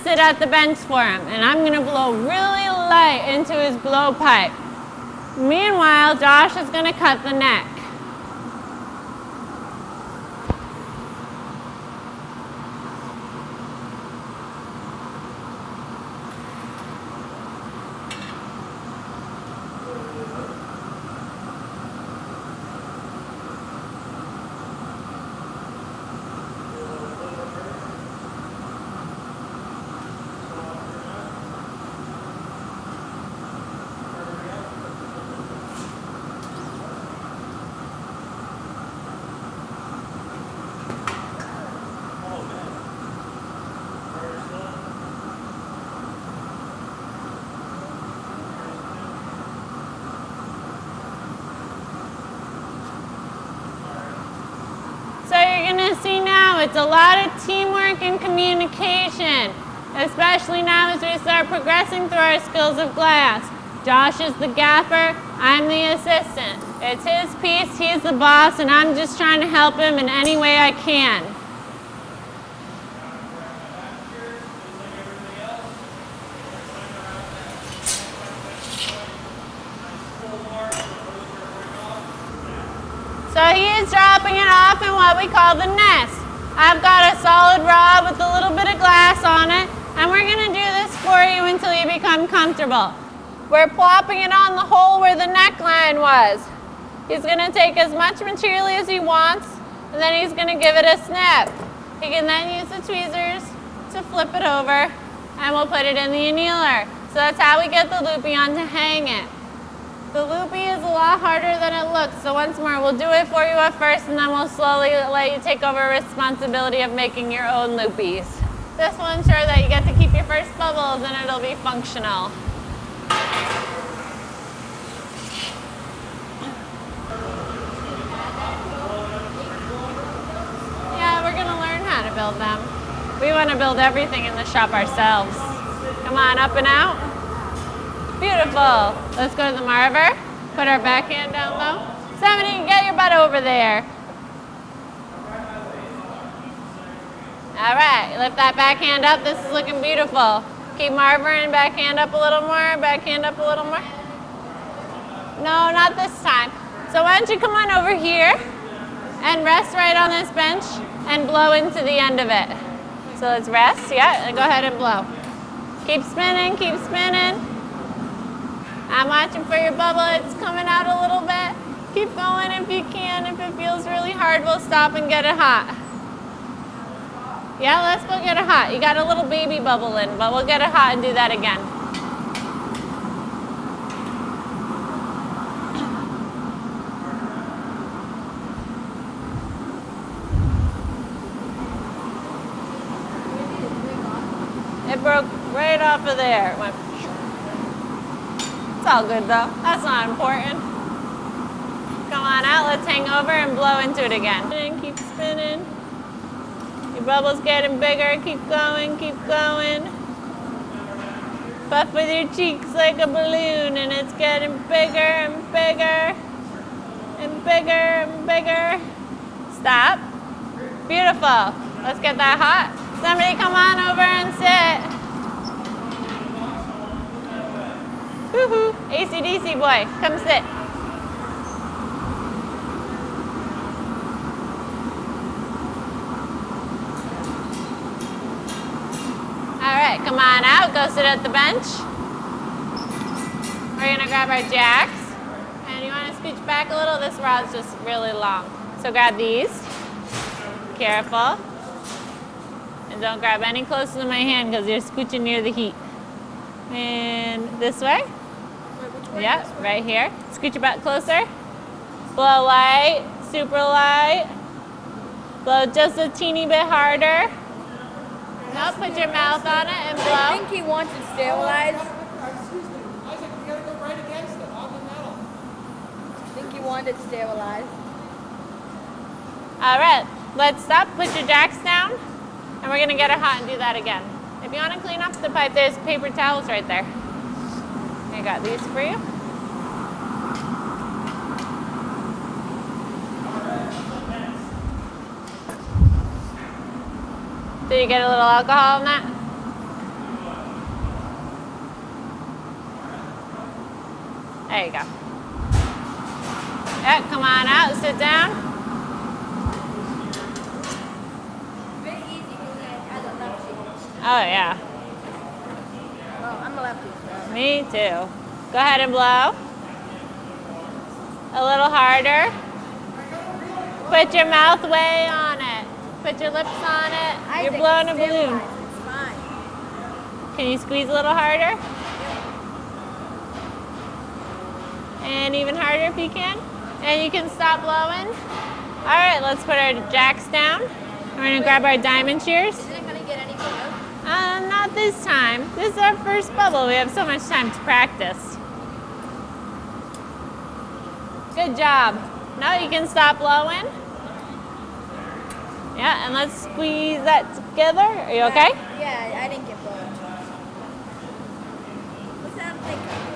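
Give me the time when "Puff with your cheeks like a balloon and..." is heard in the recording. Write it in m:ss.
3:31.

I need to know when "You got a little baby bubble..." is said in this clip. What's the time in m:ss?
2:58.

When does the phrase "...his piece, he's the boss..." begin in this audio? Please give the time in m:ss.
1:07.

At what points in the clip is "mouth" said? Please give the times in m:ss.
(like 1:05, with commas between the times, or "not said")
4:29, 5:24.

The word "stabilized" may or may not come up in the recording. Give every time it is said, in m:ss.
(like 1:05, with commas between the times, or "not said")
4:31, 4:37.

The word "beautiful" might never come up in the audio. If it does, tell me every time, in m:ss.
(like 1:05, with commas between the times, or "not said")
2:18, 2:29, 3:40.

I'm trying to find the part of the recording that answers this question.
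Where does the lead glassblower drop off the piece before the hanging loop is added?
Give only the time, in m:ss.
1:24.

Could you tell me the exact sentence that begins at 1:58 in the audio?
This will ensure that you get to keep your first bubbles and it'll be functional.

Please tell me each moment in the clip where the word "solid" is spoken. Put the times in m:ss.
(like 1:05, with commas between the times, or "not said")
1:27.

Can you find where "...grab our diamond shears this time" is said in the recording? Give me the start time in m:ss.
5:41.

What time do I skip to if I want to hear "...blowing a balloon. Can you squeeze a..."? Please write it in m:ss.
5:27.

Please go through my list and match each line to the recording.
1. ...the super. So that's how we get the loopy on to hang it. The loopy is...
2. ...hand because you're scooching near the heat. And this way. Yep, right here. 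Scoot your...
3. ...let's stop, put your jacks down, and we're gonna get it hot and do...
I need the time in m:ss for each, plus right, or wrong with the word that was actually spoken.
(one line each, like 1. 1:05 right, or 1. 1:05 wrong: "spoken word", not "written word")
1. 1:46 wrong: "annealer", not "super"
2. 4:14 right
3. 4:40 right.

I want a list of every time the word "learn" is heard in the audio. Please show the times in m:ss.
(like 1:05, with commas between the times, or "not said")
2:11.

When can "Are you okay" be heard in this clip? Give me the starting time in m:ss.
5:57.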